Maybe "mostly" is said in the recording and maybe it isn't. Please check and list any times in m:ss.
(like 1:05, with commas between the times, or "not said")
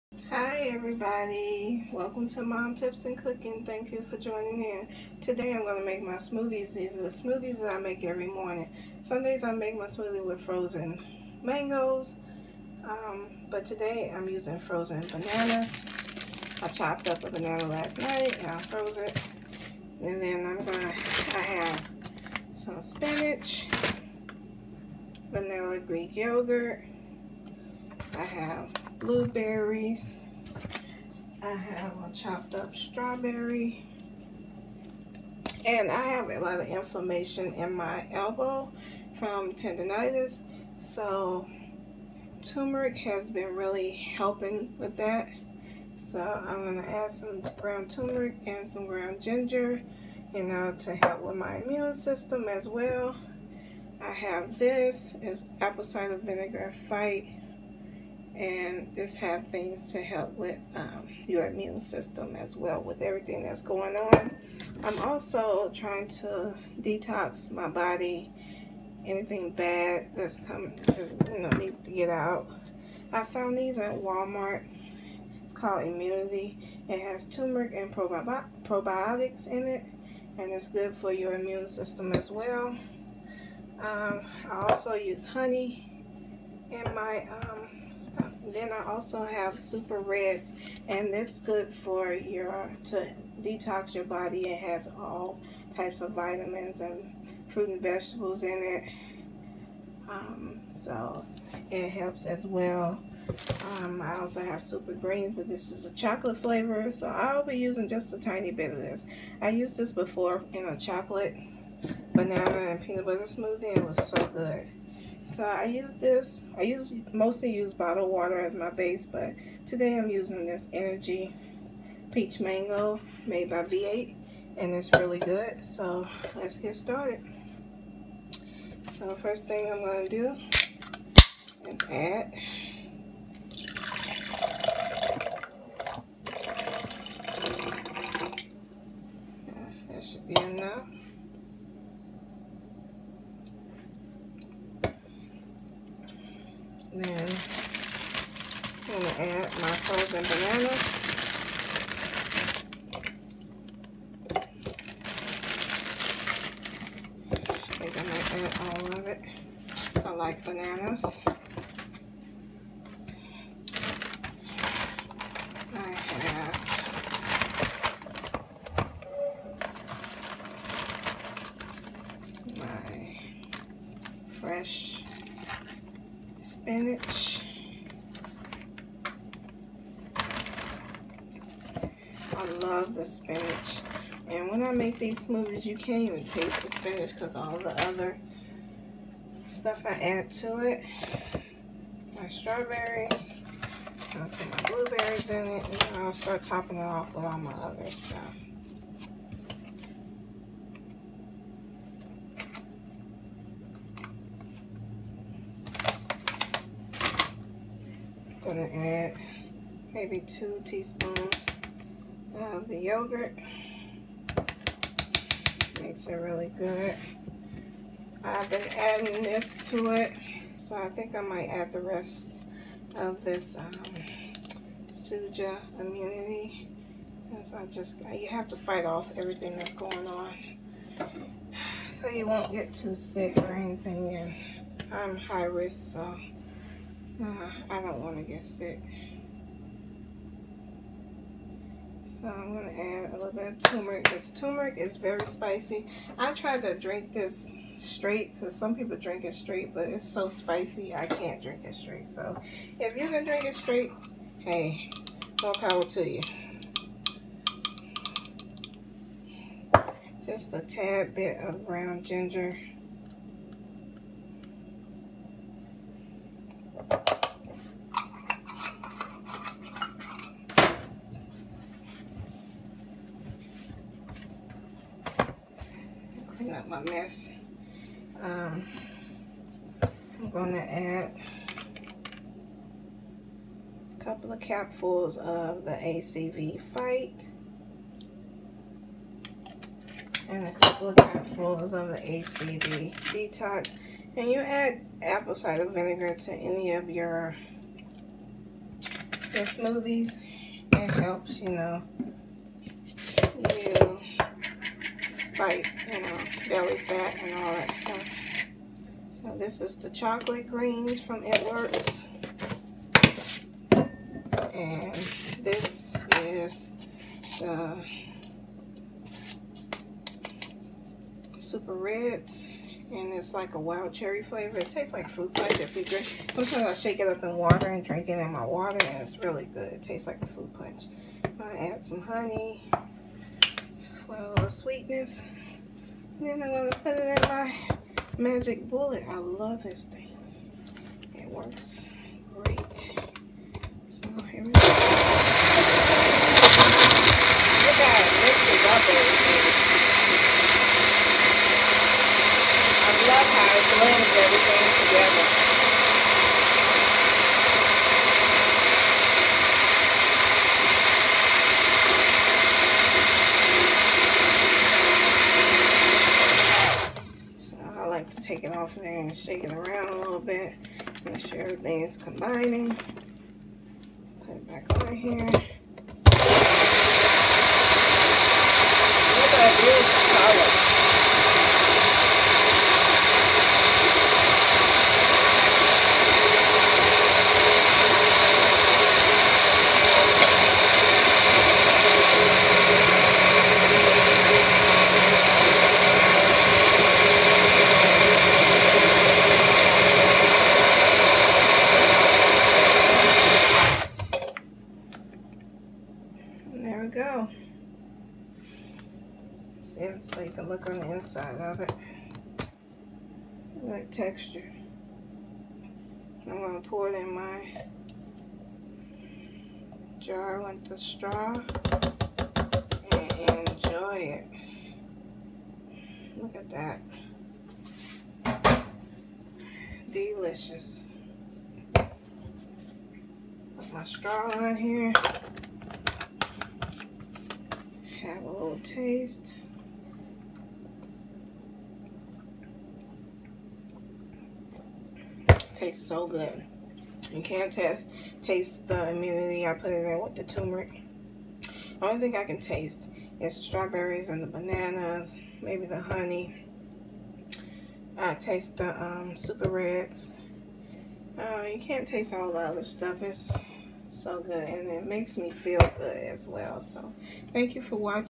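1:57.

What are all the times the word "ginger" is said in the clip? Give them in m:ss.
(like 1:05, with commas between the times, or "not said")
0:49, 4:22.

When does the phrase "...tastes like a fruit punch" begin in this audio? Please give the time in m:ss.
5:29.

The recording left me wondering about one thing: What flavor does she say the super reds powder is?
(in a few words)
Wild cherry.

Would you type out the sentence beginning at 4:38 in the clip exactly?
Um, I'm gonna add a couple of capfuls of the ACV Fight and a couple of capfuls of the ACV Detox.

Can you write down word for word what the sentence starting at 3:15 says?
And I'll start topping it off with all my other stuff.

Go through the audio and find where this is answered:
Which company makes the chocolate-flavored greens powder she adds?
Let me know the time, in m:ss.
5:11.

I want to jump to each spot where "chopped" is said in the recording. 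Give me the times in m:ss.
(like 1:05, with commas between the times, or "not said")
0:16, 0:32.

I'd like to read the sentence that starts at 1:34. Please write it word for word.
It has all types of vitamins and fruit and vegetables in it.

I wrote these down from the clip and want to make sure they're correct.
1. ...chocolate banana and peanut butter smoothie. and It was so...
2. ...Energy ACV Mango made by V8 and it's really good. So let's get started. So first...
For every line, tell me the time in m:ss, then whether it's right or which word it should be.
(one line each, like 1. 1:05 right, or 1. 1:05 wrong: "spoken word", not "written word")
1. 1:50 right
2. 2:00 wrong: "Peach", not "ACV".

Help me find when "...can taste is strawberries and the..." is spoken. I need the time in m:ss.
7:32.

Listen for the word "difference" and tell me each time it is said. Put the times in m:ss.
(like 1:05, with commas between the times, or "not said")
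not said.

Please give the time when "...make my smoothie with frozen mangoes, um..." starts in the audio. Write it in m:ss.
0:09.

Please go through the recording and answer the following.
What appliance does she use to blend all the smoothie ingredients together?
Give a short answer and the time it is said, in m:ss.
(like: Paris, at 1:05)
Magic Bullet, at 5:38.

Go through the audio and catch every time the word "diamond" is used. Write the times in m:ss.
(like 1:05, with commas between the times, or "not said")
not said.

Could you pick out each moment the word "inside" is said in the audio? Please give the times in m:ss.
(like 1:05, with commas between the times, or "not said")
6:50.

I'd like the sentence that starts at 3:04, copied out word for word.
And when I make these smoothies, you can't even taste the spinach because all the other stuff I add to it.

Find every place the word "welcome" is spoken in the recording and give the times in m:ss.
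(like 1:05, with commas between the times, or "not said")
0:01.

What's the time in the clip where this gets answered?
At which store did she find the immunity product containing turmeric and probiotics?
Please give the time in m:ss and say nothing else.
1:13.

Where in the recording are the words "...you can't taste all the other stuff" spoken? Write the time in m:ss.
7:41.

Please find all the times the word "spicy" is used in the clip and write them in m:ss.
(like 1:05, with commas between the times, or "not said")
4:05, 4:10.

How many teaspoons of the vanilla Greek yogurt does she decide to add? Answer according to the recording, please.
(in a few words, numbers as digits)
2.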